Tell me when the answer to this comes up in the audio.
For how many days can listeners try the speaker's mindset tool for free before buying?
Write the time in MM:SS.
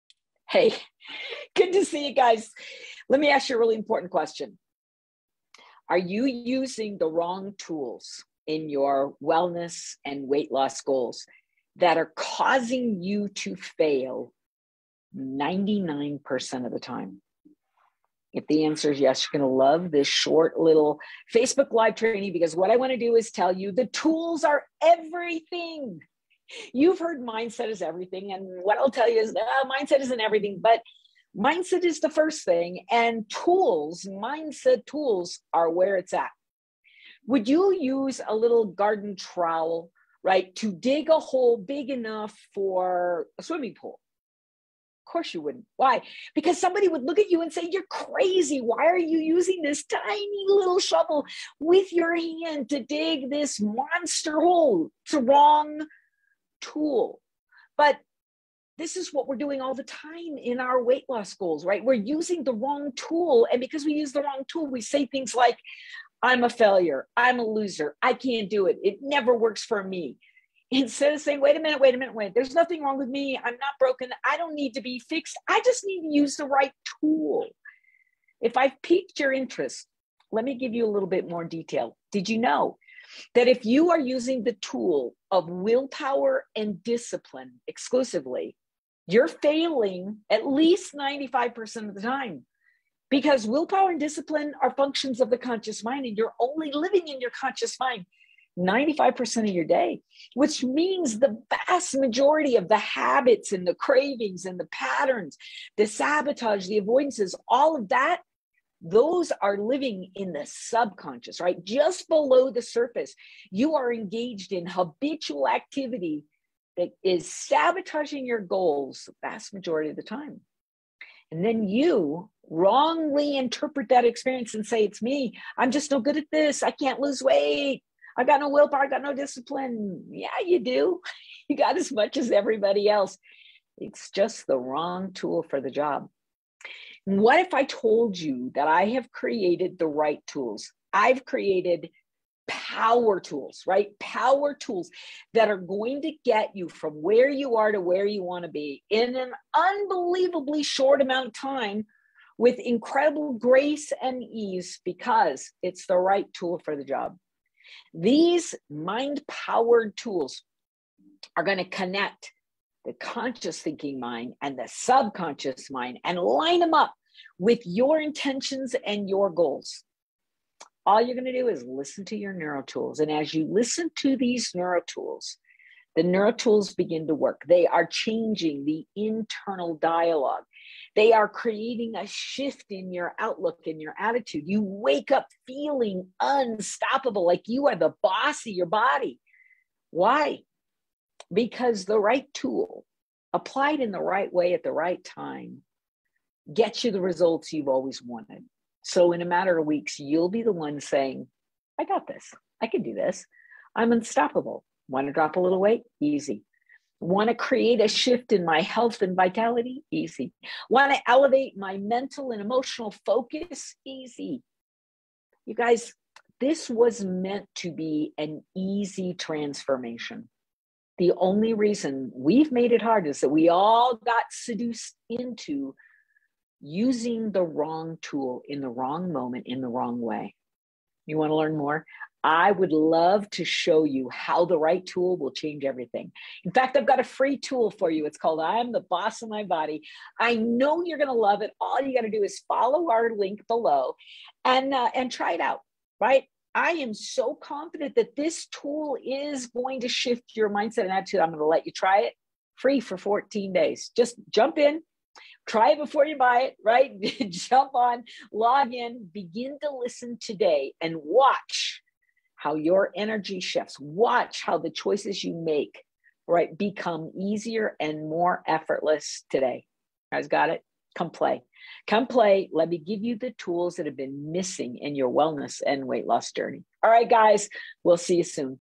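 04:12.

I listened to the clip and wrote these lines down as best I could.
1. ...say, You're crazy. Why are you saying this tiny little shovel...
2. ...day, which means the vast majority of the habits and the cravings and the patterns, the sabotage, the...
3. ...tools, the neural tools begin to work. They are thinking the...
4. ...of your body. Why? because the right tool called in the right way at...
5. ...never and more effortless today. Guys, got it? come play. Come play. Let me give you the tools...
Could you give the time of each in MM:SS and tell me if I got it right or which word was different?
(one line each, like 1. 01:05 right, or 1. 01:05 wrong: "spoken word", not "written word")
1. 00:47 wrong: "using", not "saying"
2. 01:39 right
3. 02:54 wrong: "changing", not "thinking"
4. 03:08 wrong: "applied", not "called"
5. 04:27 wrong: "easier", not "never".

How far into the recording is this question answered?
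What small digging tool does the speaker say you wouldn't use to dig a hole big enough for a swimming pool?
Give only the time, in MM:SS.
00:38.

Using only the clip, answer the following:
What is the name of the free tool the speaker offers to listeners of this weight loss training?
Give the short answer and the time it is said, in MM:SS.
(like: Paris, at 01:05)
I'm the Boss of My Body, at 03:58.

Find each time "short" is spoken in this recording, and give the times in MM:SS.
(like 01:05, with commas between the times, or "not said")
00:20, 02:30.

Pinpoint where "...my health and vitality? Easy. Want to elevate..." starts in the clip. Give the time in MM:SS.
03:28.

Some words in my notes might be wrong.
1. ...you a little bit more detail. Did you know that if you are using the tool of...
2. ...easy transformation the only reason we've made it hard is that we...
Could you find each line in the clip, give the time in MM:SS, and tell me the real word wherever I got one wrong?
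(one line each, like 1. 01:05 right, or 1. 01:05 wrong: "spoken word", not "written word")
1. 01:20 right
2. 03:38 right.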